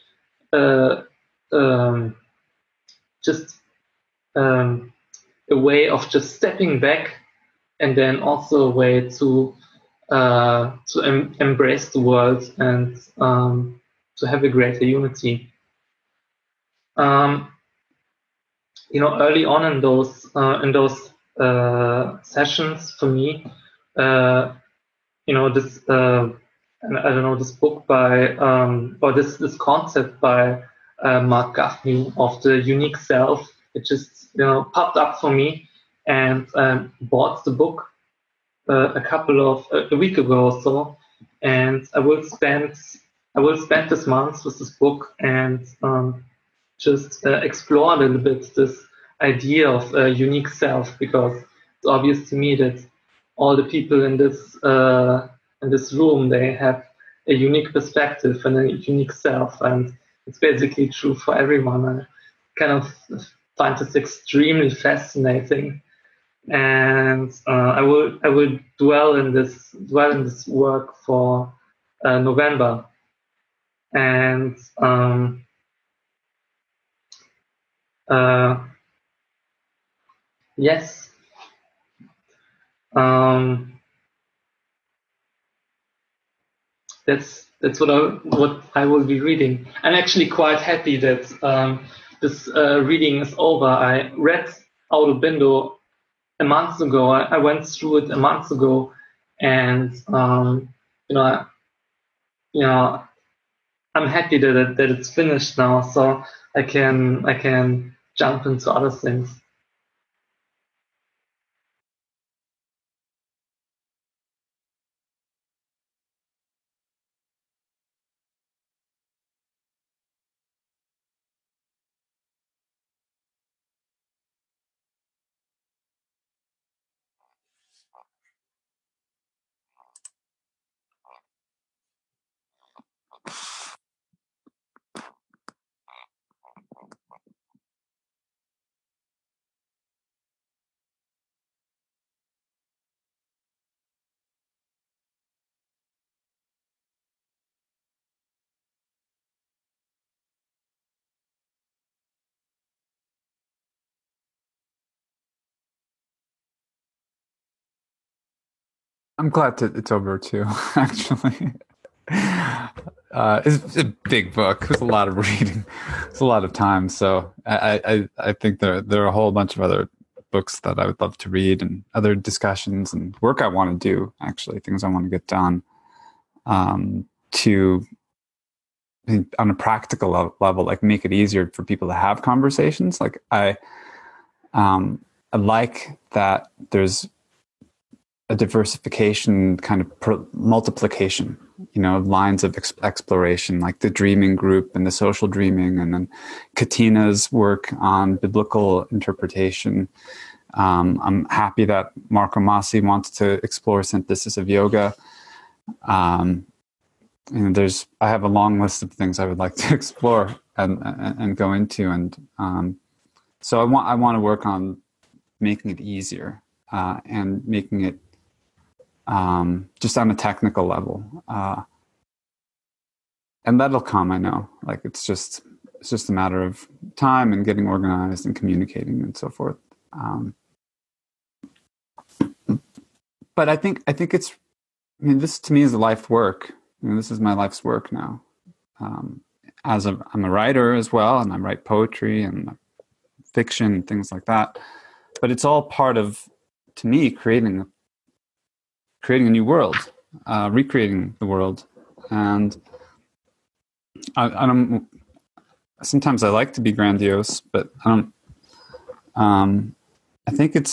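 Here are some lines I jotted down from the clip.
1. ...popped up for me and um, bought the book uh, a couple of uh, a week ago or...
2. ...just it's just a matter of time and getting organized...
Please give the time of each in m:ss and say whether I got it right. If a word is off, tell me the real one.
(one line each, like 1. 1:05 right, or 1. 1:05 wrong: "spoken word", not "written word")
1. 0:34 right
2. 3:45 right.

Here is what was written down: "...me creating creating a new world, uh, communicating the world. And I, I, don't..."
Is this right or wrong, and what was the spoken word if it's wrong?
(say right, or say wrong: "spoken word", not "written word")
wrong: "recreating", not "communicating".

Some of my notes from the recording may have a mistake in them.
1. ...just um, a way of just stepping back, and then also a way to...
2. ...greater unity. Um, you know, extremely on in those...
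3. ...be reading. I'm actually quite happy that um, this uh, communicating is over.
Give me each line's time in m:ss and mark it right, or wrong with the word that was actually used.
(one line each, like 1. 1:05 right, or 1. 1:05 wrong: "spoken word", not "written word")
1. 0:03 right
2. 0:14 wrong: "early", not "extremely"
3. 1:29 wrong: "reading", not "communicating".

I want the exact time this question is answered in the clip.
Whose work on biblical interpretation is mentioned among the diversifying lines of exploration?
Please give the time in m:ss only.
3:16.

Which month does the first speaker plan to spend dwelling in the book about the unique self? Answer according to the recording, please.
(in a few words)
November.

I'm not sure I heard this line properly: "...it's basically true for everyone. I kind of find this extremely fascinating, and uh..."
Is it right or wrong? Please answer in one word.
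right.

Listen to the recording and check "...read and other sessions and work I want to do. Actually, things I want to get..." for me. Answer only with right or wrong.
wrong.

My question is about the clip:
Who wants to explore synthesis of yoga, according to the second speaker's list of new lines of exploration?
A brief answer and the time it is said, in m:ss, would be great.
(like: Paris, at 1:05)
Marco Masi, at 3:22.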